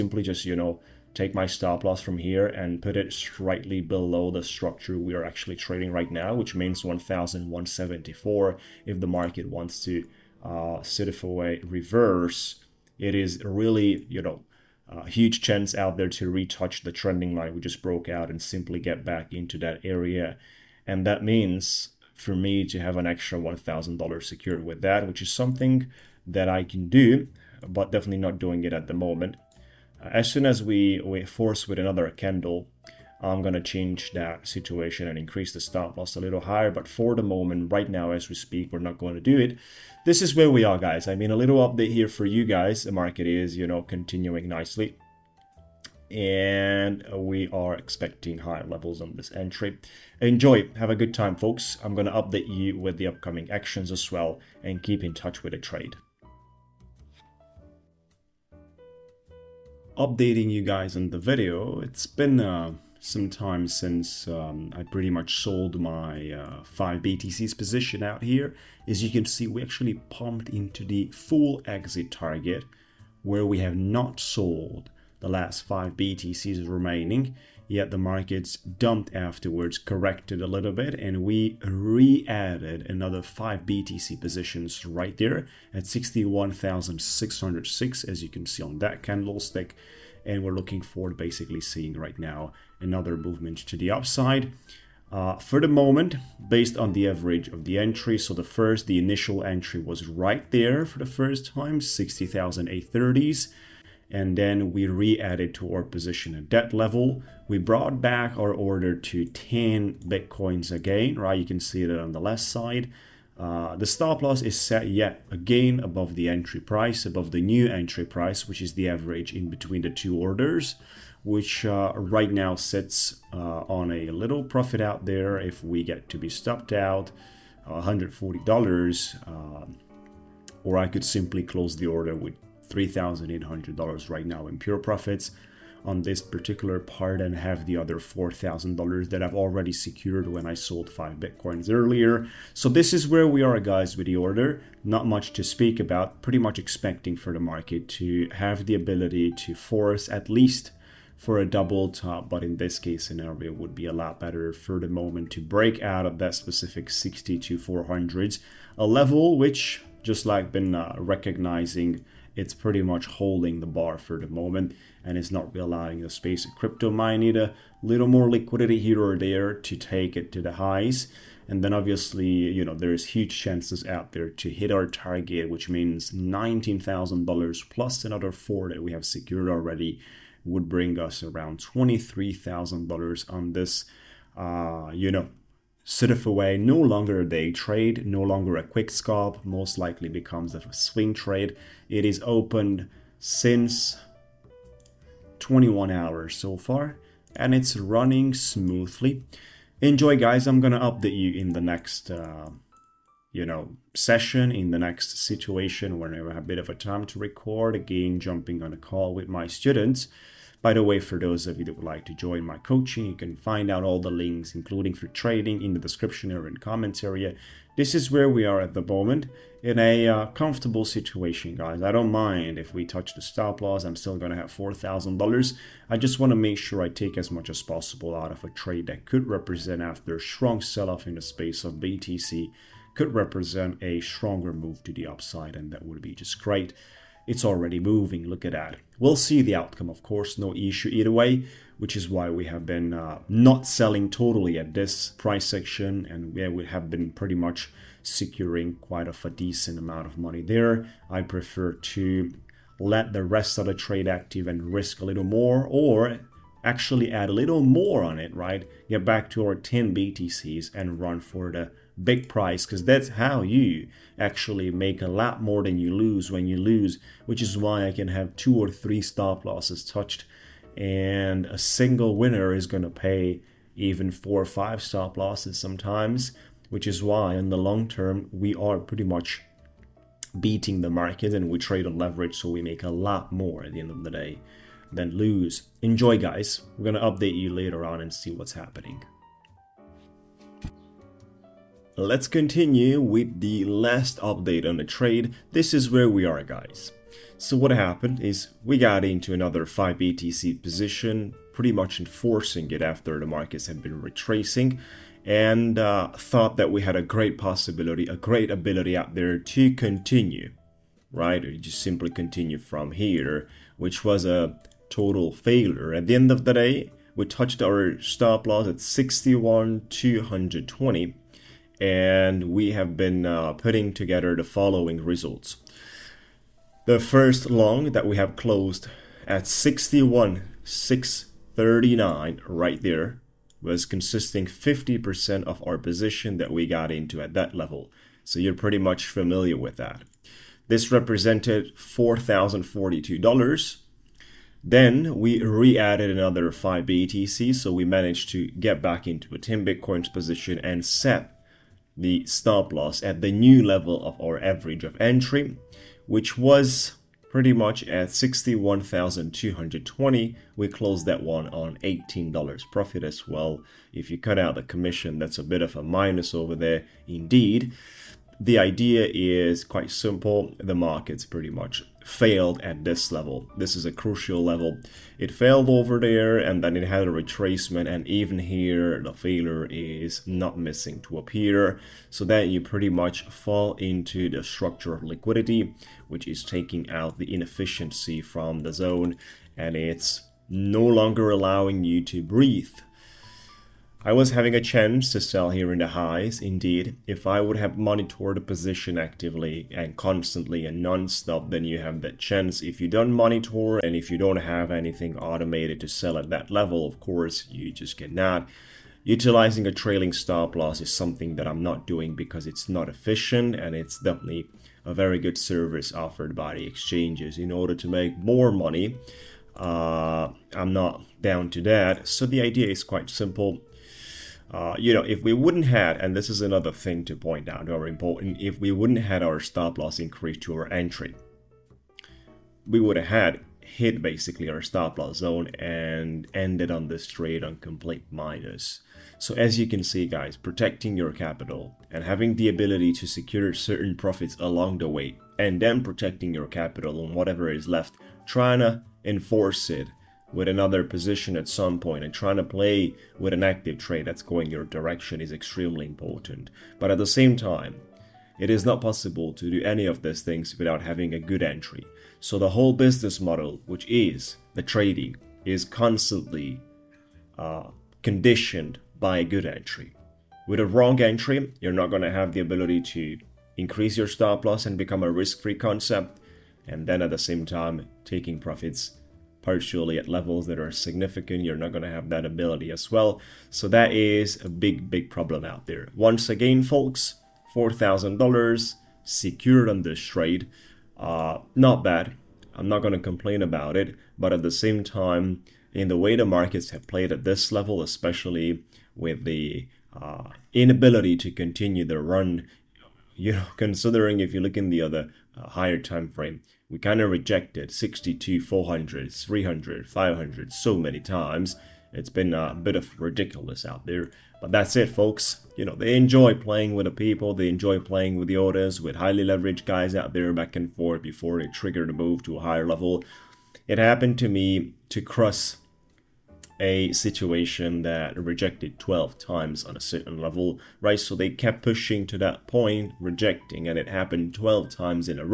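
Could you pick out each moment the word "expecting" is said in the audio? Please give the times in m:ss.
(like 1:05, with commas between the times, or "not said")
0:47, 2:26.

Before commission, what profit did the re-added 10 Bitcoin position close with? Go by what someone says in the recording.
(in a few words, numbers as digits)
$18.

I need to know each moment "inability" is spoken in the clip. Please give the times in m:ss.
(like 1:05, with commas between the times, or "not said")
8:20.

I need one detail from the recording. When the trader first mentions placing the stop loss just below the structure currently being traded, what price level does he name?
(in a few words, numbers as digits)
1,174.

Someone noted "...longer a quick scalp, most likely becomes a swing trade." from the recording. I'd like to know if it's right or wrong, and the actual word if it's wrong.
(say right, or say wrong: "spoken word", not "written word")
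right.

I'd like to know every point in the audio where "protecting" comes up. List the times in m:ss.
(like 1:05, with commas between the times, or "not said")
7:20, 7:25.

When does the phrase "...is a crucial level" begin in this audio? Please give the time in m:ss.
6:13.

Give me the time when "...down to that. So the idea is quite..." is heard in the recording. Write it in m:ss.
7:01.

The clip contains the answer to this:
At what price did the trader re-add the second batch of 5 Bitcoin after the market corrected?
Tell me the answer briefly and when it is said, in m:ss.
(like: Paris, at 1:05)
61,606, at 1:25.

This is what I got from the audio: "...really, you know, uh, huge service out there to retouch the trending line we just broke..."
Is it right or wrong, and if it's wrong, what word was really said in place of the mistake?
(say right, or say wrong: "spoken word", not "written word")
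wrong: "chance", not "service".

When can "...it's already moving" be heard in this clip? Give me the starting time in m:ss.
3:57.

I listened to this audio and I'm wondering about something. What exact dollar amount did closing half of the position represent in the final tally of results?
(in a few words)
$4,042.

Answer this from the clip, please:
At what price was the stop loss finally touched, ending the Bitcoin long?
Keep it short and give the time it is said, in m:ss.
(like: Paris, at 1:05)
61,220, at 5:18.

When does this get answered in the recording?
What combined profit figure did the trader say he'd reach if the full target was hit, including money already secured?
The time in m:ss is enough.
3:01.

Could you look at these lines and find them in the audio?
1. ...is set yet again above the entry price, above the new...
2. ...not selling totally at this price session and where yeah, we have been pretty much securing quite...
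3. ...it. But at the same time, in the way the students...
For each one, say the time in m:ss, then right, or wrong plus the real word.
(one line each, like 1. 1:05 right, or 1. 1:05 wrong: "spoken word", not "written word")
1. 1:54 right
2. 4:03 wrong: "section", not "session"
3. 8:13 wrong: "markets", not "students".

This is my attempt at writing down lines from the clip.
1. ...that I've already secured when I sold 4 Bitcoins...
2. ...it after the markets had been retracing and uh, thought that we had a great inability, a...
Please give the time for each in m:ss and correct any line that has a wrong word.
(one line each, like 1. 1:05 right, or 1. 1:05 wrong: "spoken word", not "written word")
1. 2:19 wrong: "5", not "4"
2. 5:02 wrong: "possibility", not "inability".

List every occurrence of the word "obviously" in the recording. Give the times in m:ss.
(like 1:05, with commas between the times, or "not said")
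2:51.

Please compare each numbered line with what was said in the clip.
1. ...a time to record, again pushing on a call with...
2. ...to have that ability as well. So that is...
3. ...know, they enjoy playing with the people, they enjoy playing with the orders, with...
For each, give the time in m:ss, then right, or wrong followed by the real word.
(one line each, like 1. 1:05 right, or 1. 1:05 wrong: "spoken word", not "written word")
1. 3:26 wrong: "jumping", not "pushing"
2. 8:01 right
3. 8:35 right.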